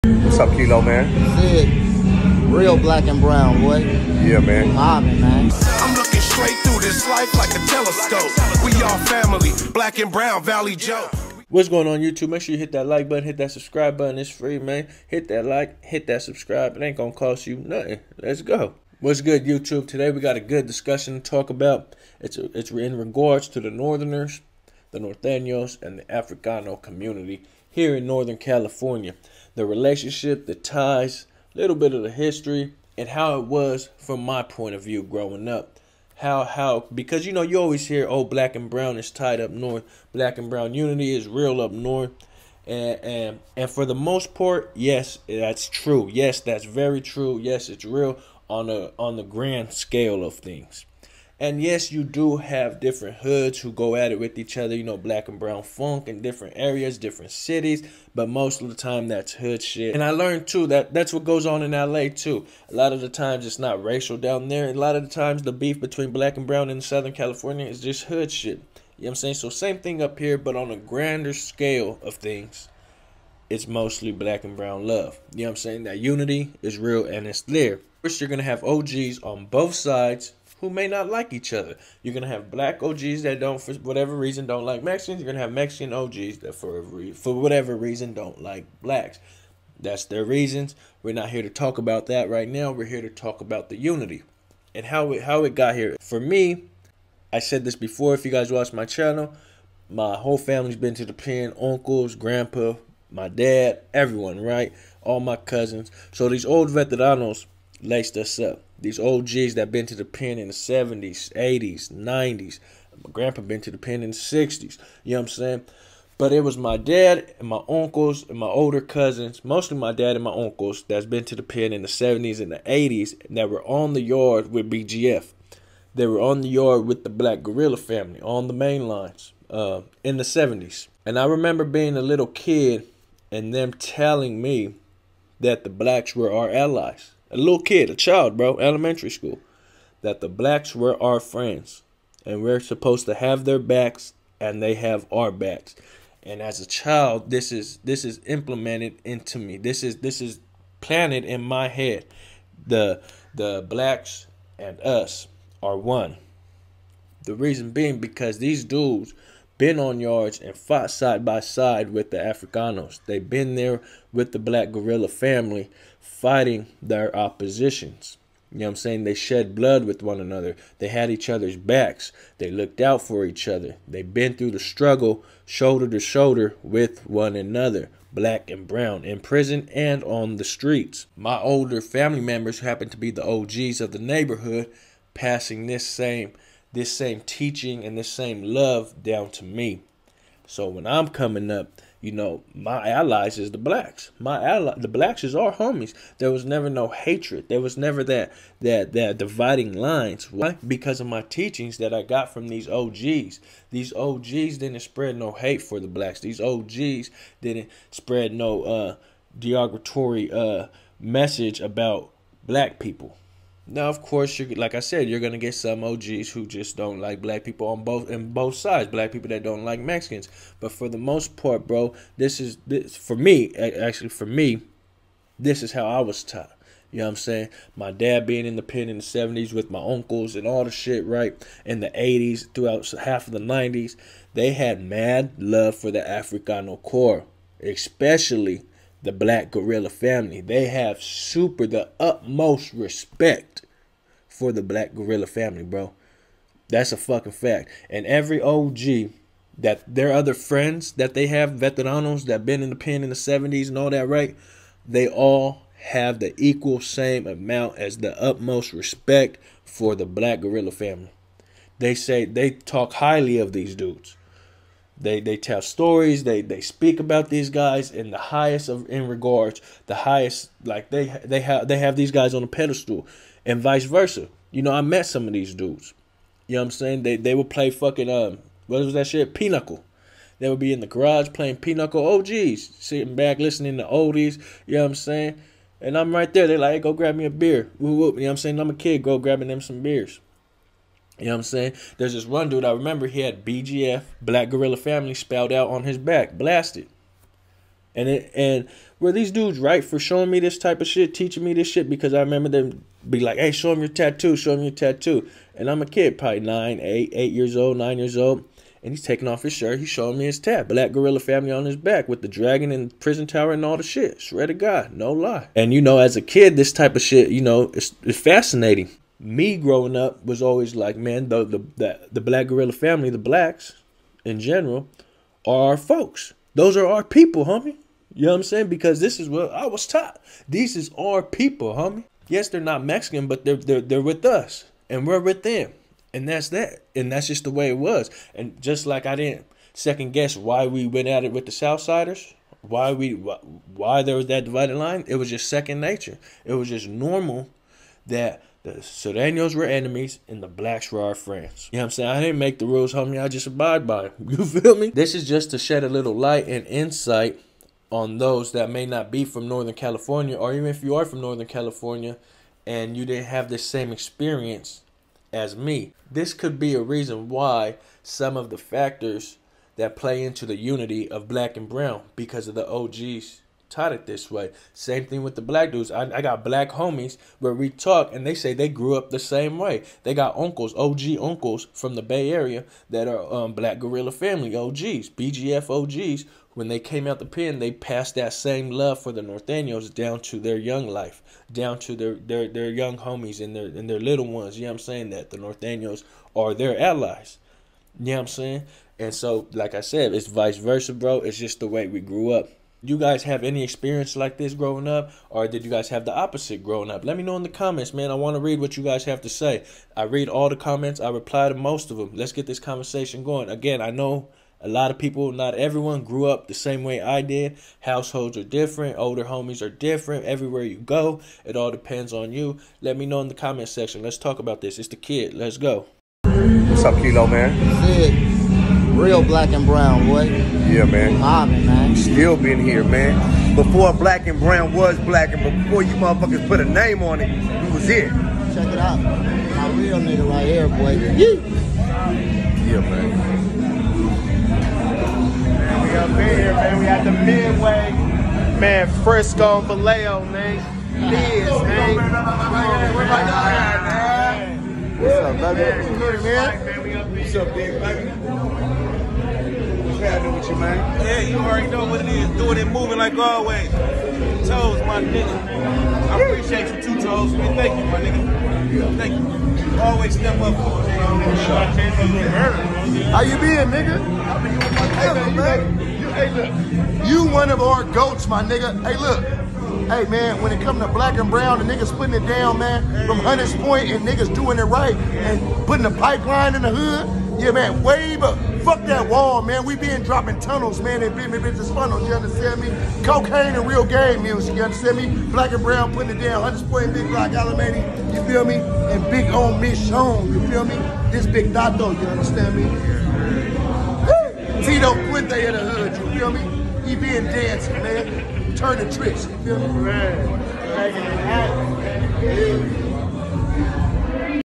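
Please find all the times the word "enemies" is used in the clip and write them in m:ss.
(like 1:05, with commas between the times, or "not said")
5:49.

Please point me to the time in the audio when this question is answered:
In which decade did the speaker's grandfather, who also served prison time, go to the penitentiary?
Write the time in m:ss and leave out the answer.
1:54.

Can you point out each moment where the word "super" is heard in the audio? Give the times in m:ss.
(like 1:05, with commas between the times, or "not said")
4:01.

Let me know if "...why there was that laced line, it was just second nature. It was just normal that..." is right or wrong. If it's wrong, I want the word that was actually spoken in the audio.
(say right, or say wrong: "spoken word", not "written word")
wrong: "divided", not "laced".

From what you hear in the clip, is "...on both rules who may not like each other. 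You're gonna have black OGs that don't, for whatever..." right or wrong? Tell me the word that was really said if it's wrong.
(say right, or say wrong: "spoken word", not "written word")
wrong: "sides", not "rules".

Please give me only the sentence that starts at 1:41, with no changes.
Uncles, grandpa, my dad, everyone, right?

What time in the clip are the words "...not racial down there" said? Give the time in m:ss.
1:03.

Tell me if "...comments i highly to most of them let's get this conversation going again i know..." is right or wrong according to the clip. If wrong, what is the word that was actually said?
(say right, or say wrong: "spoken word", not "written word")
wrong: "reply", not "highly".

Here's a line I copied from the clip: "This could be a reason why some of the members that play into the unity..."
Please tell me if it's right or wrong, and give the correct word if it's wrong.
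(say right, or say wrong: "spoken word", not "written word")
wrong: "factors", not "members".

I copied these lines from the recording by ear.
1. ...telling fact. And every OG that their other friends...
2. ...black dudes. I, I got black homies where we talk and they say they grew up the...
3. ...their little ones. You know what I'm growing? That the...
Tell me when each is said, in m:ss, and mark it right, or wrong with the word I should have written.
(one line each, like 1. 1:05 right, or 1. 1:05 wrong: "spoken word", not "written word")
1. 4:06 wrong: "fucking", not "telling"
2. 6:15 right
3. 6:33 wrong: "saying", not "growing".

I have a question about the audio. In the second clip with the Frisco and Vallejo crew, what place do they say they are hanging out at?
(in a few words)
the Midway.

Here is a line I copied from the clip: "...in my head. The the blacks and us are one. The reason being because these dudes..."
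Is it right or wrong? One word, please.
right.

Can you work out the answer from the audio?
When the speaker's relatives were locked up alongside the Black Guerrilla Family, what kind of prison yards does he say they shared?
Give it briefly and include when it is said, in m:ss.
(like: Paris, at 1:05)
main lines, at 2:08.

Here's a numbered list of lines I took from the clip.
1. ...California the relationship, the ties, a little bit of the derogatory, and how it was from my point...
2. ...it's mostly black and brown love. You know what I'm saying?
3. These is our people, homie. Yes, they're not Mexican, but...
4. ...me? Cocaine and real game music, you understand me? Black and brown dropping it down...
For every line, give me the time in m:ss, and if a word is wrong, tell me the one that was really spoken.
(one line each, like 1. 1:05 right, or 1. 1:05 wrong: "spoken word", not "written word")
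1. 0:28 wrong: "history", not "derogatory"
2. 1:13 right
3. 5:30 right
4. 8:12 wrong: "putting", not "dropping".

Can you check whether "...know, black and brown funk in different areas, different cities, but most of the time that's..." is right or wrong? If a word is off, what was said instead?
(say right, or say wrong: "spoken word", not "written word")
right.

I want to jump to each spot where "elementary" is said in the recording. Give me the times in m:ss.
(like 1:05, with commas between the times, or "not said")
2:18.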